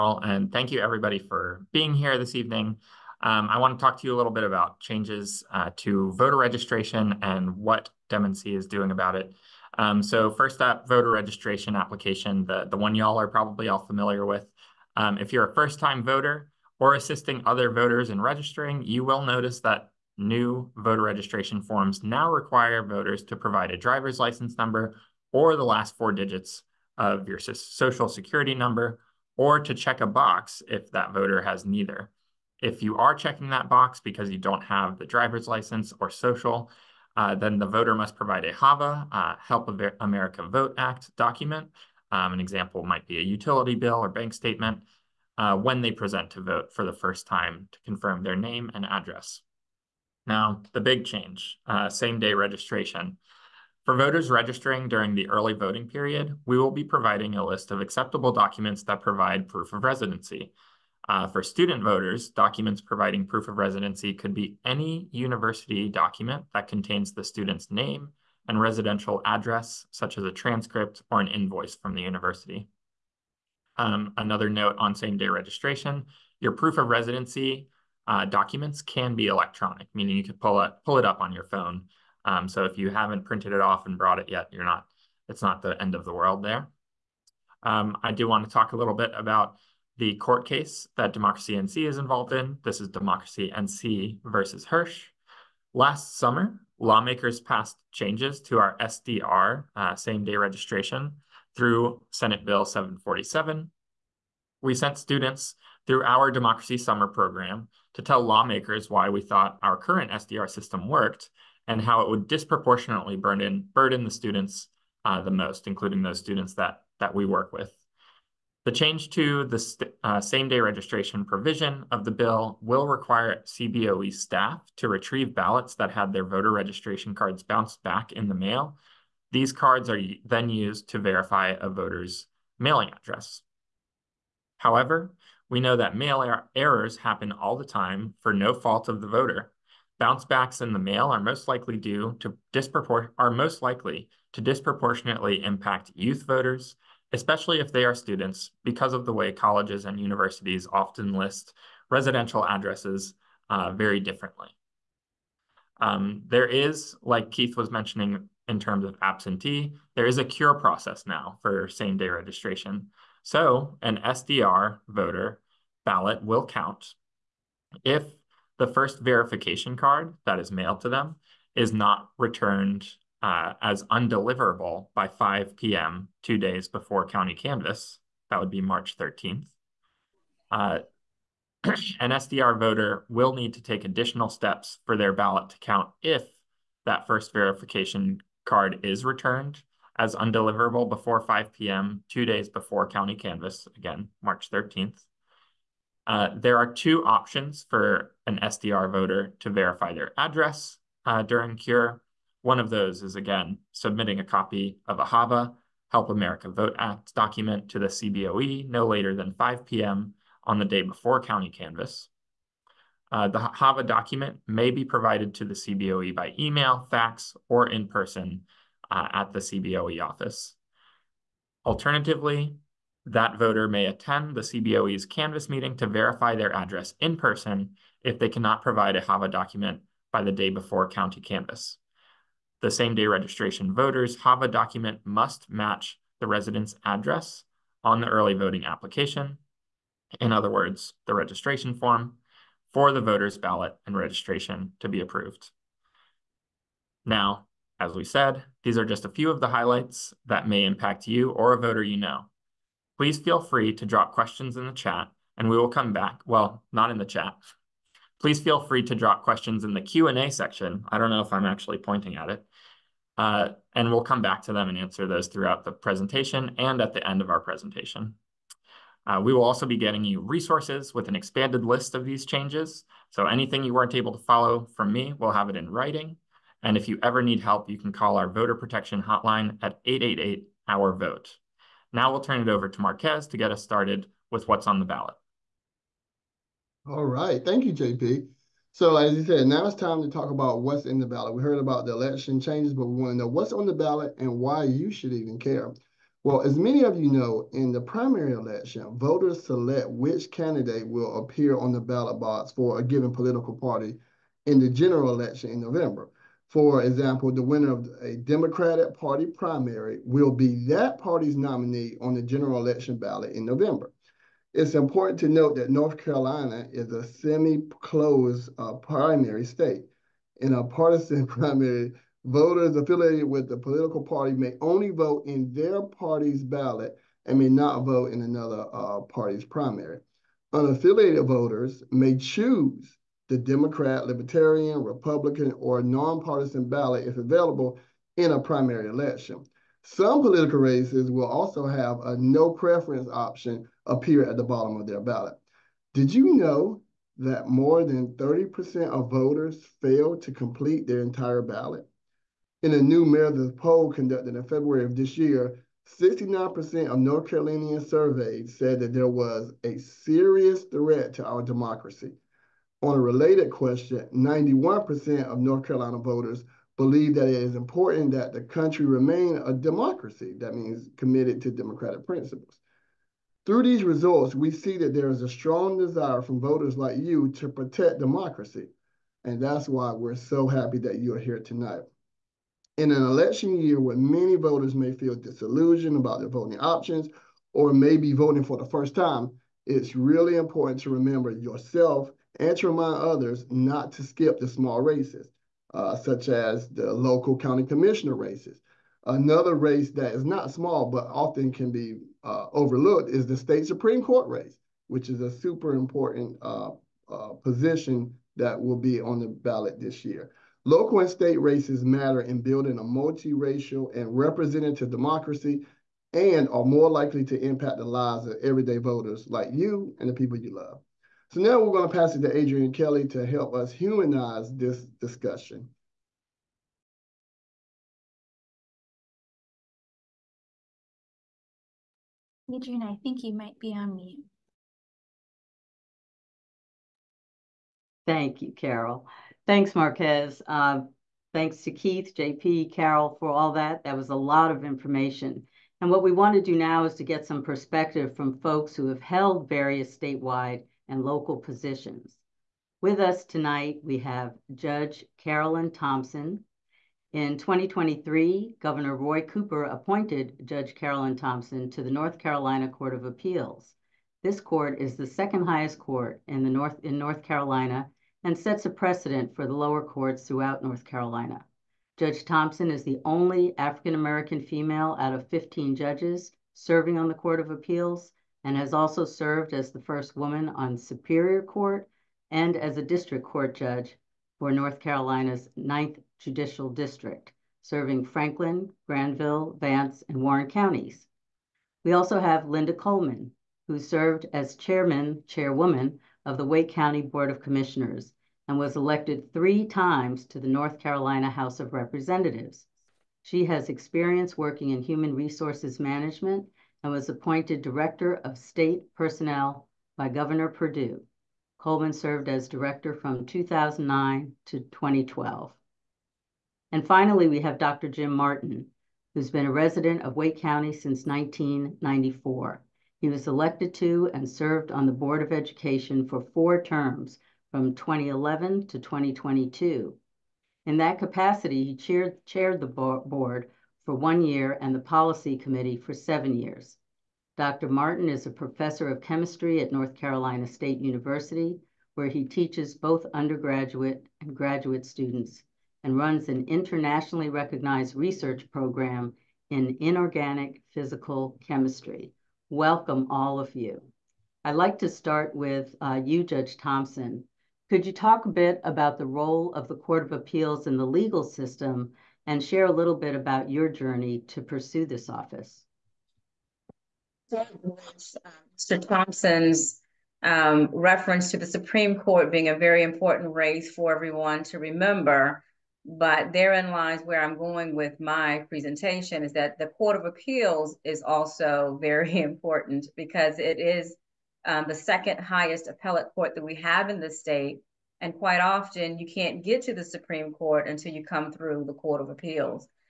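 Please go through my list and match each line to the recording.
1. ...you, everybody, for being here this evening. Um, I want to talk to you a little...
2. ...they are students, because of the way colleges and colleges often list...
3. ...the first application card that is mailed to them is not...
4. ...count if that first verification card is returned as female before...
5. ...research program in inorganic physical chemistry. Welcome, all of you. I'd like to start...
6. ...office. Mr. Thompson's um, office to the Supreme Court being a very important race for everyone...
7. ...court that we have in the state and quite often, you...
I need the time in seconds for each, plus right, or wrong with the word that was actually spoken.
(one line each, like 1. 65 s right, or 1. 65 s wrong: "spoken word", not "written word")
1. 0 s right
2. 147 s wrong: "universities", not "colleges"
3. 168 s wrong: "verification", not "application"
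4. 185 s wrong: "undeliverable", not "female"
5. 547 s right
6. 565 s wrong: "reference", not "office"
7. 586 s right.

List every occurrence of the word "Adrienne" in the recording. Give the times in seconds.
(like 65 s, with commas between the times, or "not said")
422 s, 432 s.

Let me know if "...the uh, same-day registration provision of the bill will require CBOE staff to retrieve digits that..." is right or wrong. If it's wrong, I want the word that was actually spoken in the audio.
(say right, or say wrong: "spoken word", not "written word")
wrong: "ballots", not "digits".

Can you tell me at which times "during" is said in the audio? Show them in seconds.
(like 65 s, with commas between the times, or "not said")
54 s, 201 s.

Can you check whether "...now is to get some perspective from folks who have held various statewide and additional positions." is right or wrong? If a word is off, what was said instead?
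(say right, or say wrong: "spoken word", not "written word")
wrong: "local", not "additional".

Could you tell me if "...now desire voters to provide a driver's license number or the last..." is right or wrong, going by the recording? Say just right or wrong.
wrong.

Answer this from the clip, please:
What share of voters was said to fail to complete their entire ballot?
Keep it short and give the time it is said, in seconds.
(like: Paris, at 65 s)
more than 30%, at 347 s.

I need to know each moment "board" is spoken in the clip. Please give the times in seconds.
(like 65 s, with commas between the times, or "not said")
497 s, 524 s, 532 s.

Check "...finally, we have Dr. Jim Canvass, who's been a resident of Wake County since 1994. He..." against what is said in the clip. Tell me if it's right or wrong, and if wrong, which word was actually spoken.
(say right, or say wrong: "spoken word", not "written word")
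wrong: "Martin", not "Canvass".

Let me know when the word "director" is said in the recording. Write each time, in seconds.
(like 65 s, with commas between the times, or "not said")
507 s, 512 s.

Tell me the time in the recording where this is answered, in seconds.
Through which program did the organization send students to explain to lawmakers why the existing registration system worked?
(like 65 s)
106 s.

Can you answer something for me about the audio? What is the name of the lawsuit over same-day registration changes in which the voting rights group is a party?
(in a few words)
Democracy NC versus Hirsch.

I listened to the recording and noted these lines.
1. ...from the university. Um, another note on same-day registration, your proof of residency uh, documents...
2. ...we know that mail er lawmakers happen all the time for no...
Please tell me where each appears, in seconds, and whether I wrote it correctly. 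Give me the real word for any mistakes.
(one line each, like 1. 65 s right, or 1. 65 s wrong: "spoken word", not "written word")
1. 71 s right
2. 135 s wrong: "errors", not "lawmakers".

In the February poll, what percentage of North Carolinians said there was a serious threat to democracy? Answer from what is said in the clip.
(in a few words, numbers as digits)
69%.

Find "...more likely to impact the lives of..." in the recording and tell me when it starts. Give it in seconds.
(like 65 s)
416 s.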